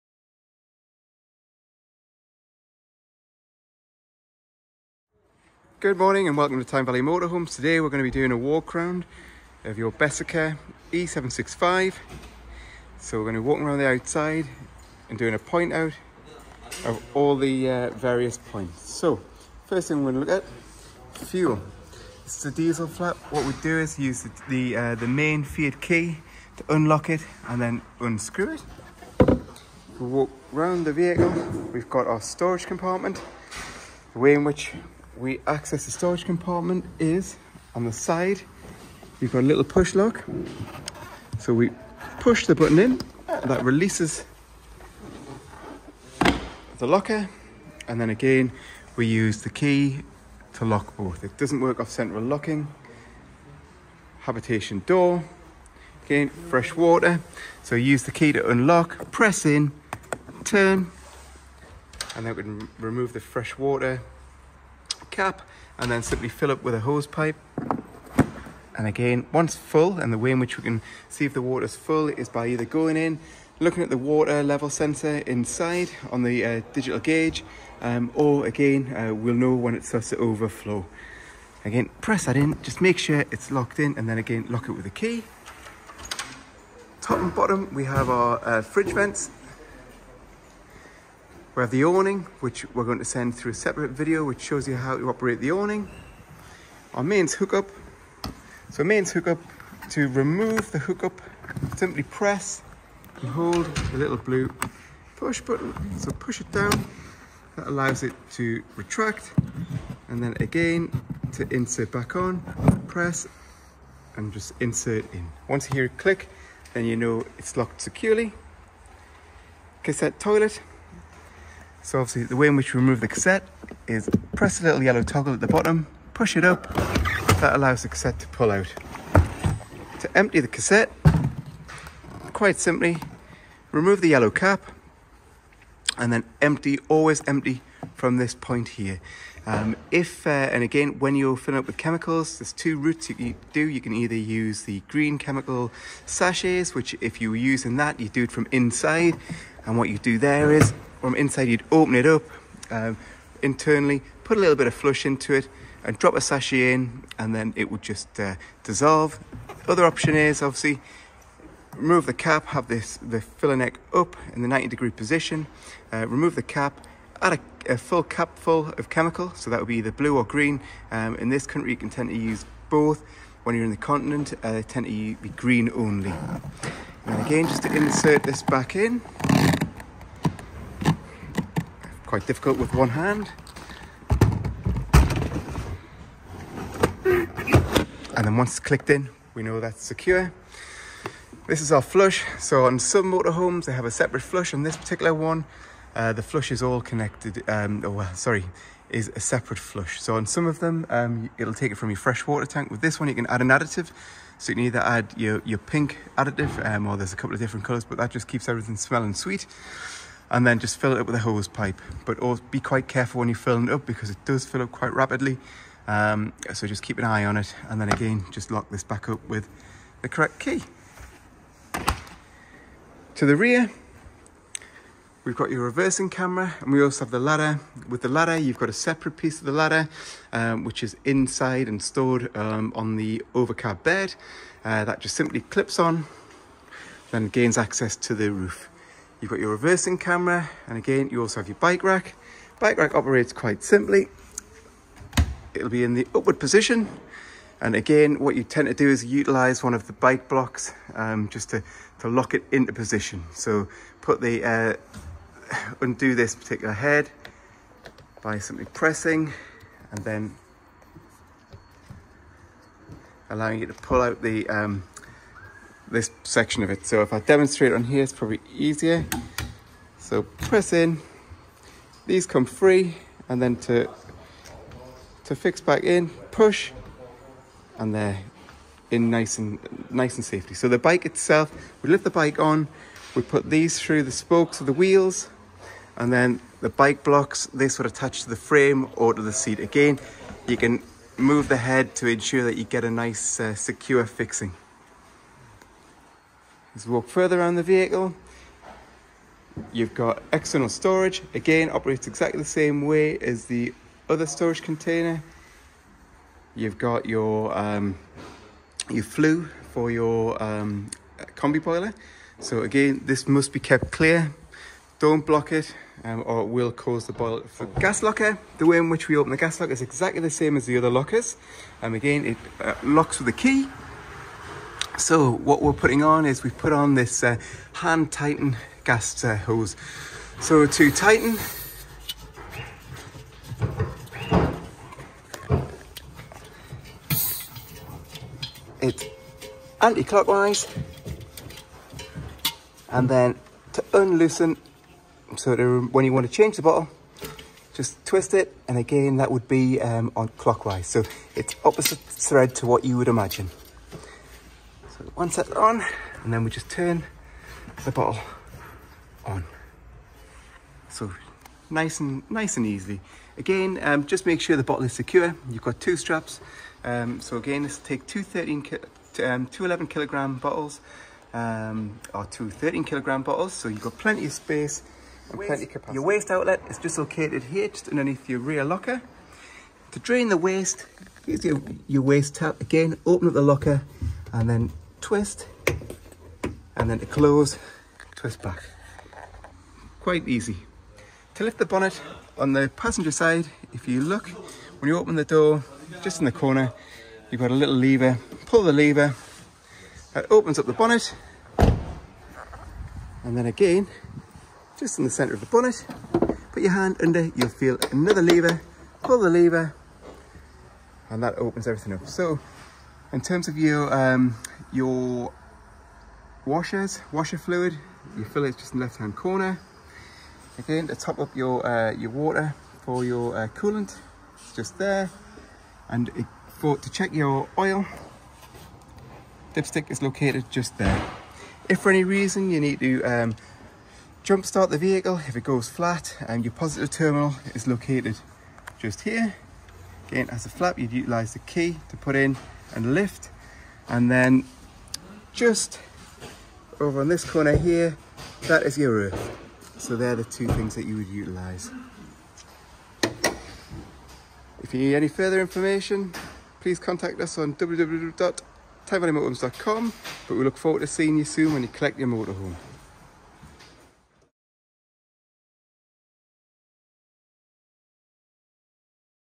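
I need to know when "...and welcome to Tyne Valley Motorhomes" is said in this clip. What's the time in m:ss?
0:06.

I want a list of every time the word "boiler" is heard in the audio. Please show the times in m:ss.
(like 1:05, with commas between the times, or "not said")
5:11, 5:17.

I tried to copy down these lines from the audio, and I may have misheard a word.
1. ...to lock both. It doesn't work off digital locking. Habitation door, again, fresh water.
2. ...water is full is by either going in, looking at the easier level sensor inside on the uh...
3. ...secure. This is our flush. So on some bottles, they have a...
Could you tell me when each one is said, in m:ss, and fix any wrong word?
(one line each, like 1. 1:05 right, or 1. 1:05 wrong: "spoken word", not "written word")
1. 0:50 wrong: "central", not "digital"
2. 1:11 wrong: "water", not "easier"
3. 3:09 wrong: "motorhomes", not "bottles".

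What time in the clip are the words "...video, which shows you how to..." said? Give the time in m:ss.
1:33.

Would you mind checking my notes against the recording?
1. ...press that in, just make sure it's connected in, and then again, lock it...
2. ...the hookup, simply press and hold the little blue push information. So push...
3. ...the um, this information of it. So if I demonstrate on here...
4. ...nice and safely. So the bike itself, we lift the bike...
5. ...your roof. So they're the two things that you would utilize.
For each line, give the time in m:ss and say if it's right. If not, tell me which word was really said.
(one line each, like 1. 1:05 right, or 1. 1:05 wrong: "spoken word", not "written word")
1. 1:21 wrong: "locked", not "connected"
2. 1:40 wrong: "button", not "information"
3. 4:24 wrong: "section", not "information"
4. 4:39 right
5. 7:28 right.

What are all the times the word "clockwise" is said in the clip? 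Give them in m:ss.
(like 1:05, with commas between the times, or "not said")
5:39, 5:50.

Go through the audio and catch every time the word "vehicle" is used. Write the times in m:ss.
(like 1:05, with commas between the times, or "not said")
0:30, 4:57, 7:14.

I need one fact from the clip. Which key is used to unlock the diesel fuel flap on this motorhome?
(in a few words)
Main Fiat key.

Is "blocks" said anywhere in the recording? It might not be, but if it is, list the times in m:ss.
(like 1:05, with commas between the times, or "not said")
4:10, 4:47, 5:15.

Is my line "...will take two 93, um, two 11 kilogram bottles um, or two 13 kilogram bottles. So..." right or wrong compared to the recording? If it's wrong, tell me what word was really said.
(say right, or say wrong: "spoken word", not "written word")
wrong: "13", not "93".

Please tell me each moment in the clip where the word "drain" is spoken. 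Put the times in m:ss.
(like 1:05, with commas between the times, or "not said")
6:19.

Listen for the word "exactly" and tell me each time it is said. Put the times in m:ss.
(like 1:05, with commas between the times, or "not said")
5:02, 5:19.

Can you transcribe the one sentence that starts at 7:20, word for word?
Again, as a flap, you'd utilize the key to put in and lift.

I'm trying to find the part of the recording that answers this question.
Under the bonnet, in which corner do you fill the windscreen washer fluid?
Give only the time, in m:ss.
6:58.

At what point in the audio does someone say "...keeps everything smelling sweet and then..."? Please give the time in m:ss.
3:28.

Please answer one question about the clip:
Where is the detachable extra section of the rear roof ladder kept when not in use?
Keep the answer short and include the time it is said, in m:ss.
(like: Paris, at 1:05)
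On the overcab bed, at 3:52.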